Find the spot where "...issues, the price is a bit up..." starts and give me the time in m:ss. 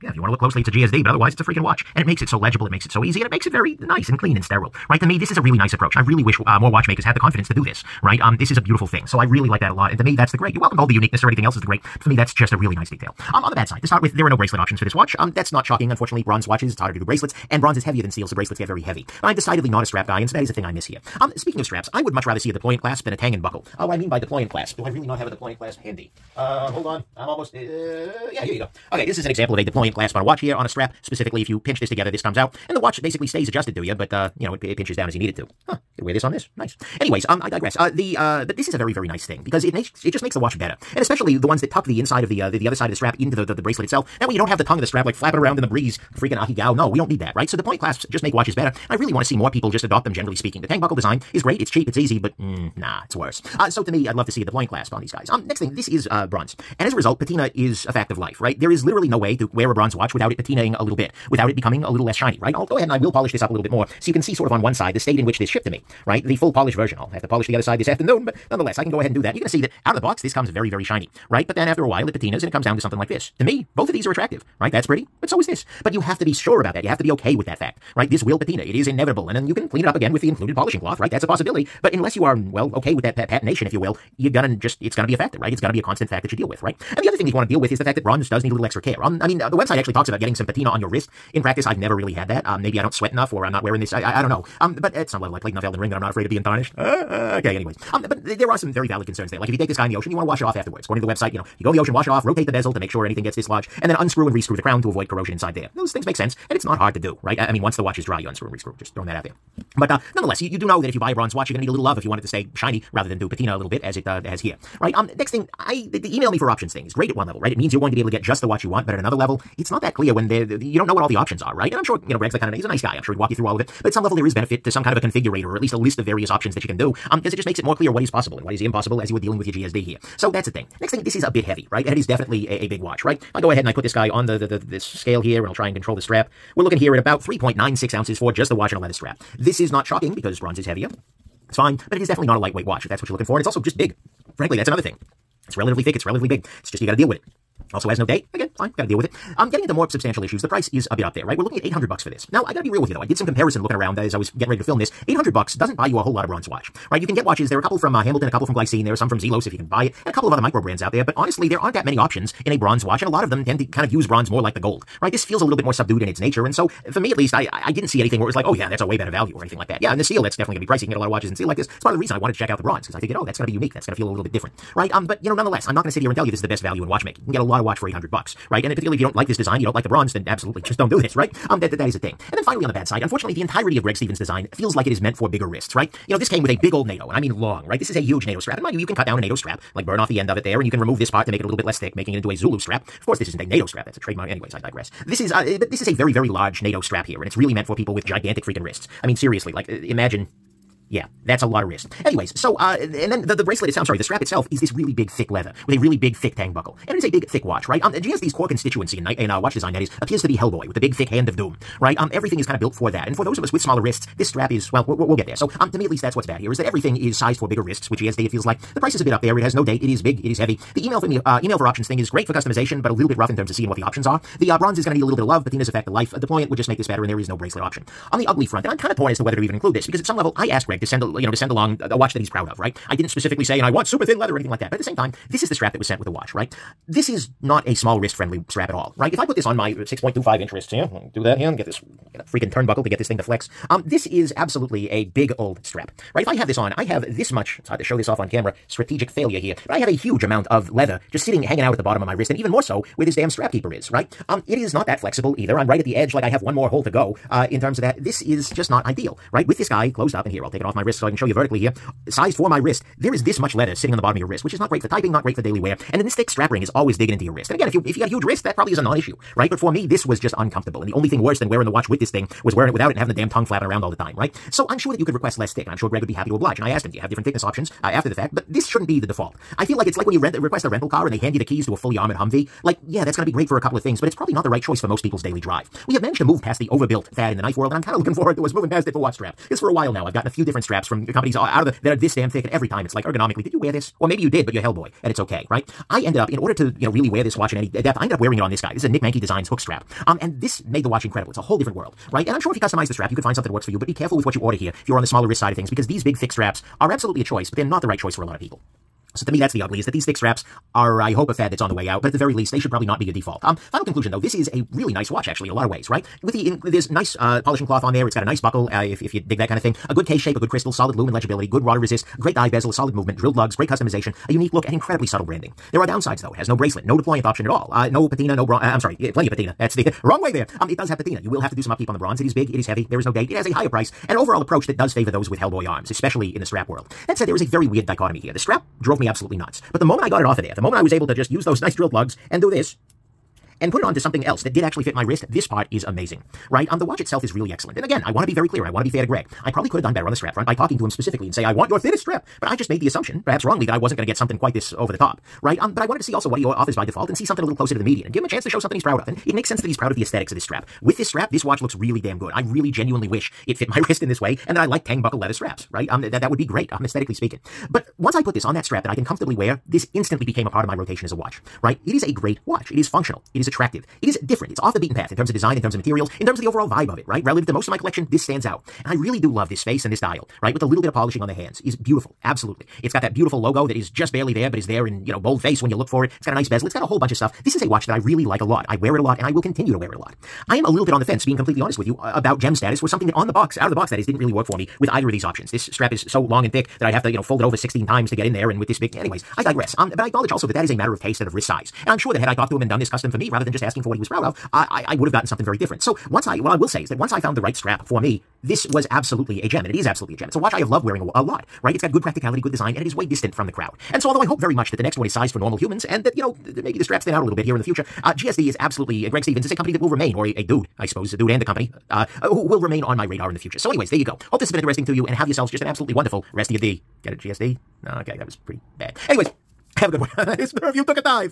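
2:30.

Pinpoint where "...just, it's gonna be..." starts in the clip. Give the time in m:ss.
1:24.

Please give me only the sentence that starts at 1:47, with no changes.
I, I mean, once the watch is dry, you unscrew and rescrew.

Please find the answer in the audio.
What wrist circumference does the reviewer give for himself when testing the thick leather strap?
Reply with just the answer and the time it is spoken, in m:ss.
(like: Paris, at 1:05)
6.25 inches, at 3:59.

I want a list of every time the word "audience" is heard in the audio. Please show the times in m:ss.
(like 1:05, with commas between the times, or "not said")
not said.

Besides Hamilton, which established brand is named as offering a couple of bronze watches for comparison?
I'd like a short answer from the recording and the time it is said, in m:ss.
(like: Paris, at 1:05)
Glycine, at 2:38.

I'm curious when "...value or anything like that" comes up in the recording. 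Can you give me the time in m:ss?
2:49.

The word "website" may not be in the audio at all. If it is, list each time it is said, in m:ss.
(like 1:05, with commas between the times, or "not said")
1:29, 1:41.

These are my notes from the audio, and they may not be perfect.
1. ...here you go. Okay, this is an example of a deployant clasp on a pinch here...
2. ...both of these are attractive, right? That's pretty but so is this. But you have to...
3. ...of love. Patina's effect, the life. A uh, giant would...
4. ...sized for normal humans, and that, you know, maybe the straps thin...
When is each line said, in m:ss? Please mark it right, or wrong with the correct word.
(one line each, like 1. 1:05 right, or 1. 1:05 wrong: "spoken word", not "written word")
1. 0:28 wrong: "watch", not "pinch"
2. 1:13 right
3. 3:45 wrong: "deployant", not "giant"
4. 6:55 right.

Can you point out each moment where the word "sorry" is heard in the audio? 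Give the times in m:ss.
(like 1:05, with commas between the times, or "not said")
3:23, 5:28.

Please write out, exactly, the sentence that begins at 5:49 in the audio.
I probably could have done better on the strap front by talking to him specifically and say, I want your thinnest strap.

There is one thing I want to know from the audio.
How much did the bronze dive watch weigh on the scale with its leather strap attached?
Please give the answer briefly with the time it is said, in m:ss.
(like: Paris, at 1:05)
3.96 ounces, at 2:17.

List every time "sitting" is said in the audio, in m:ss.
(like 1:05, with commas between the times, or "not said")
4:11, 4:23.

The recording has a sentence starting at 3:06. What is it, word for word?
You know, this came with a big old NATO, and I mean long, right?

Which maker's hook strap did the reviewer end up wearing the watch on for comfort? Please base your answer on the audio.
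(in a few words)
Nick Mankey Designs.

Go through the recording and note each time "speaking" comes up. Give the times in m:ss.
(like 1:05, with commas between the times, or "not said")
0:21, 0:50, 6:07.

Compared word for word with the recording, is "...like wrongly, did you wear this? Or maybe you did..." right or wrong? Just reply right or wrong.
wrong.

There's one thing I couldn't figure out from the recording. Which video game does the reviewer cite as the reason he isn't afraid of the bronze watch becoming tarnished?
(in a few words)
Elden Ring.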